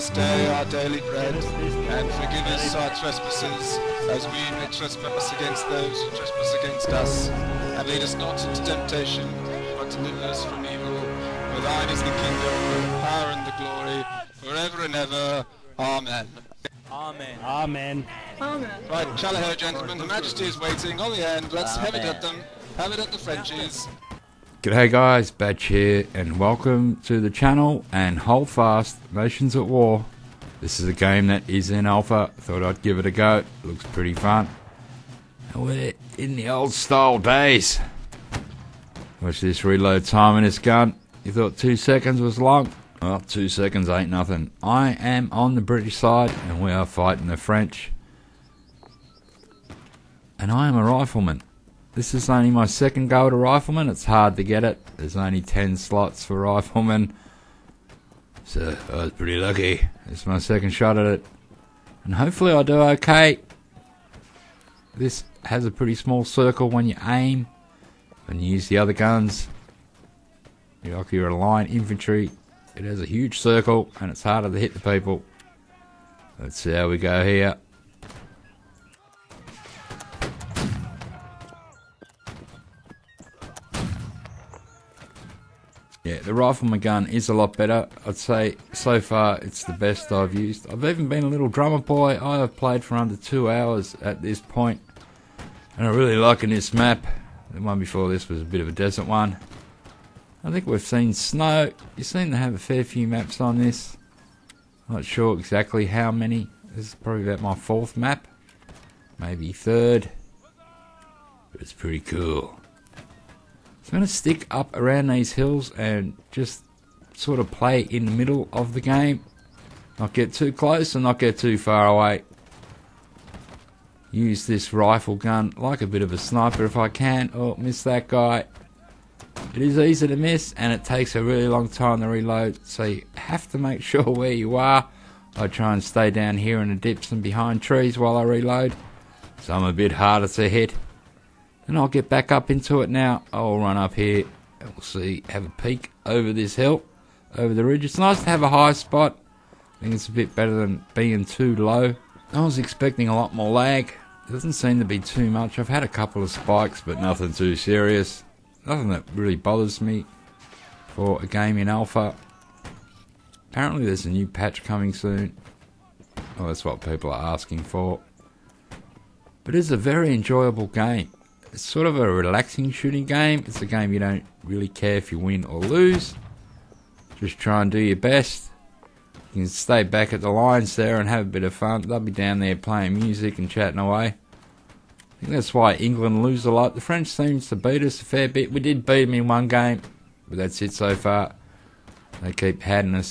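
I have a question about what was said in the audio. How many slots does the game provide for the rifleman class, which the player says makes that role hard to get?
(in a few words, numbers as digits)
10.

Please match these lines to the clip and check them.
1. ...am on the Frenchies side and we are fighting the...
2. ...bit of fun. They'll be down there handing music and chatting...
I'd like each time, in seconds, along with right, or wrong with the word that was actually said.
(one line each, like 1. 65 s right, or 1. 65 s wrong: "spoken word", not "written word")
1. 44 s wrong: "British", not "Frenchies"
2. 181 s wrong: "playing", not "handing".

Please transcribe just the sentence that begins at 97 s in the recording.
The one before this was a bit of a desert one.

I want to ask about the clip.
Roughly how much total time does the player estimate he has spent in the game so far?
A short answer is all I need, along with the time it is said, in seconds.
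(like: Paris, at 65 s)
under two hours, at 92 s.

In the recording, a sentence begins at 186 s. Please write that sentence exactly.
The French seems to beat us a fair bit.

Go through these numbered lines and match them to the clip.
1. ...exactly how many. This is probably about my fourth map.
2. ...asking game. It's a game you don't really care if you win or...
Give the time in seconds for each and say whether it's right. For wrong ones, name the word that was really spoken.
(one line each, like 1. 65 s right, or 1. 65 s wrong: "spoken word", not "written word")
1. 105 s right
2. 172 s wrong: "shooting", not "asking".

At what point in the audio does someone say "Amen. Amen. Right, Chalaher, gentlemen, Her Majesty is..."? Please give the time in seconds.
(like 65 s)
17 s.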